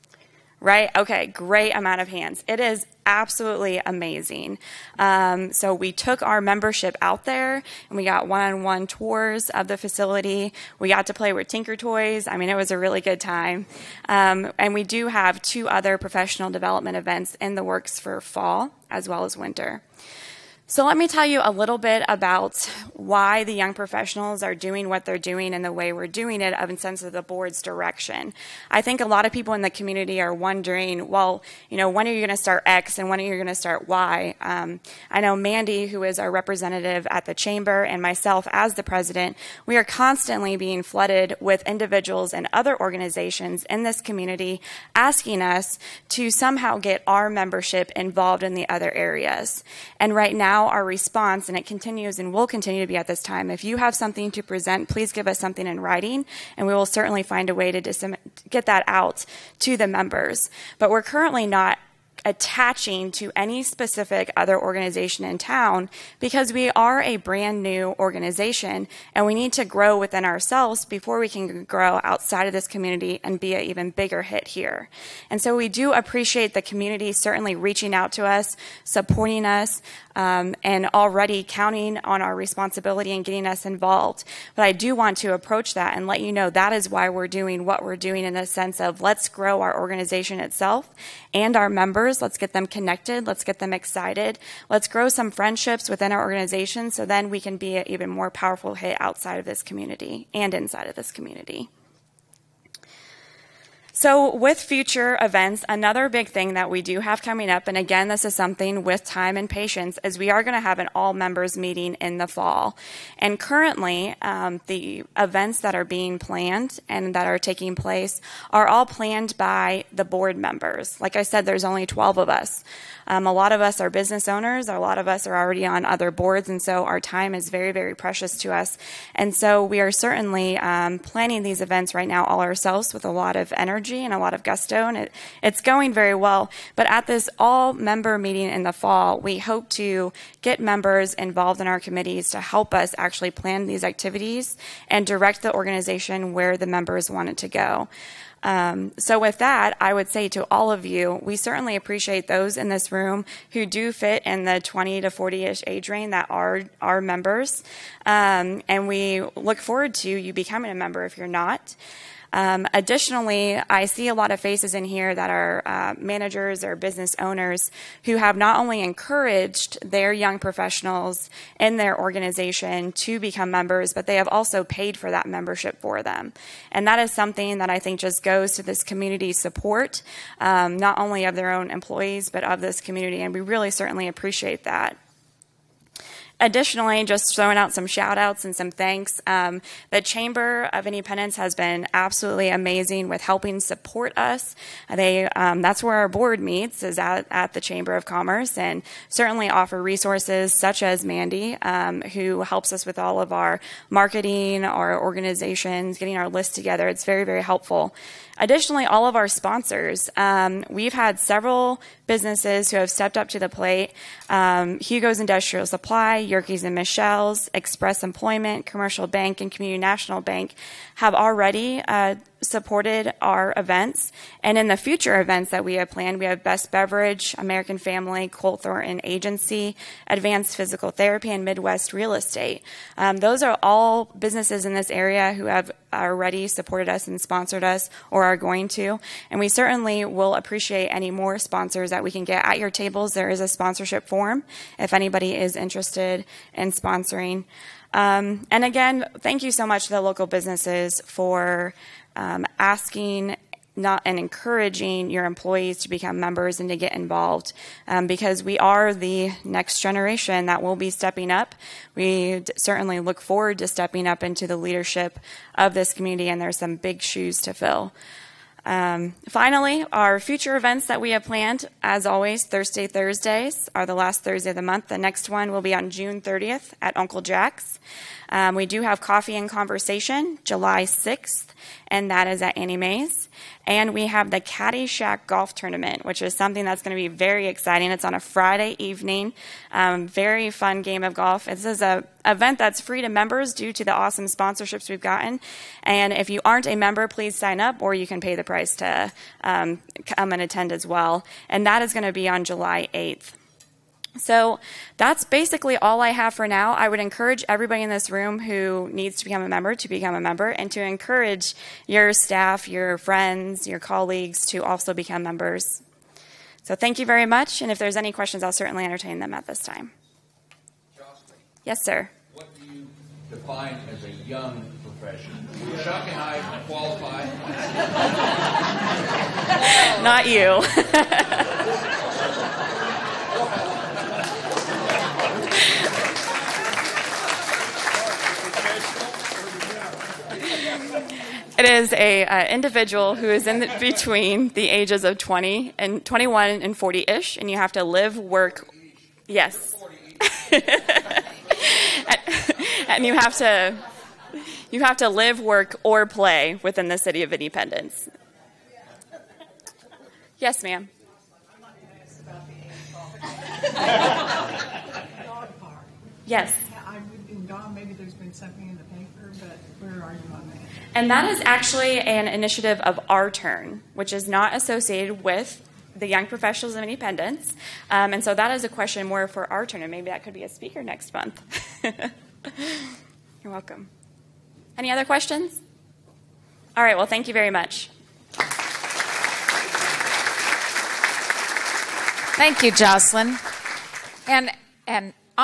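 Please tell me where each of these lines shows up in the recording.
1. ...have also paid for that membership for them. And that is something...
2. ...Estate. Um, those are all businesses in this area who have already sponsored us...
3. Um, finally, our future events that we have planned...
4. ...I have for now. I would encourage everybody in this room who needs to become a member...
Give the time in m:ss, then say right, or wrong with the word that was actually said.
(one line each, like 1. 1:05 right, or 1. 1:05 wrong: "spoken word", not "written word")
1. 2:54 right
2. 3:52 wrong: "supported", not "sponsored"
3. 4:28 right
4. 5:06 right.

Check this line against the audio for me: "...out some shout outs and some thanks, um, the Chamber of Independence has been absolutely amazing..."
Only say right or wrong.
right.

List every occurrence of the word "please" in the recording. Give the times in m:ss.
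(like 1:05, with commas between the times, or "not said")
0:54, 4:57.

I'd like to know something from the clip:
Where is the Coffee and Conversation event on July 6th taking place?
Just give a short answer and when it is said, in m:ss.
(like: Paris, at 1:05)
Annie Mae's, at 4:42.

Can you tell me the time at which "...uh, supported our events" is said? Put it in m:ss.
3:41.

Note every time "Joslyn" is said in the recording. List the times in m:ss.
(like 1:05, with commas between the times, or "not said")
5:20, 6:32.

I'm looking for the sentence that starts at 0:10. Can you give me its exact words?
We got to play with Tinker Toys.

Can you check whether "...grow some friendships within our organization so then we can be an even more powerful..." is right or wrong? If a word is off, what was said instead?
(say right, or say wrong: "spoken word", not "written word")
right.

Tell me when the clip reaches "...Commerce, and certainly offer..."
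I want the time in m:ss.
3:18.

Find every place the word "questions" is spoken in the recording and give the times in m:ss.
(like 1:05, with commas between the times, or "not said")
5:18, 6:18, 6:25.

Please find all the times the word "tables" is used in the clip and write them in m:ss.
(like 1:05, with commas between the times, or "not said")
4:02.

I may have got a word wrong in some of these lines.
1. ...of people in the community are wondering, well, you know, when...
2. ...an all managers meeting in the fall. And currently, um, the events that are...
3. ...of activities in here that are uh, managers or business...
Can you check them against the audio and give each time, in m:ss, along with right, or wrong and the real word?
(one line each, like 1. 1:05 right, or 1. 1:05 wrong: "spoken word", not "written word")
1. 0:29 right
2. 1:50 wrong: "members", not "managers"
3. 2:44 wrong: "faces", not "activities".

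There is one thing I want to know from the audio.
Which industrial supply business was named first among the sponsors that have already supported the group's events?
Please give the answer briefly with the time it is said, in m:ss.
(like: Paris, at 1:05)
Hugo's Industrial Supply, at 3:34.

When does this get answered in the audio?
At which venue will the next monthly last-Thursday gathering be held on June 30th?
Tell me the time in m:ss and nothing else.
4:36.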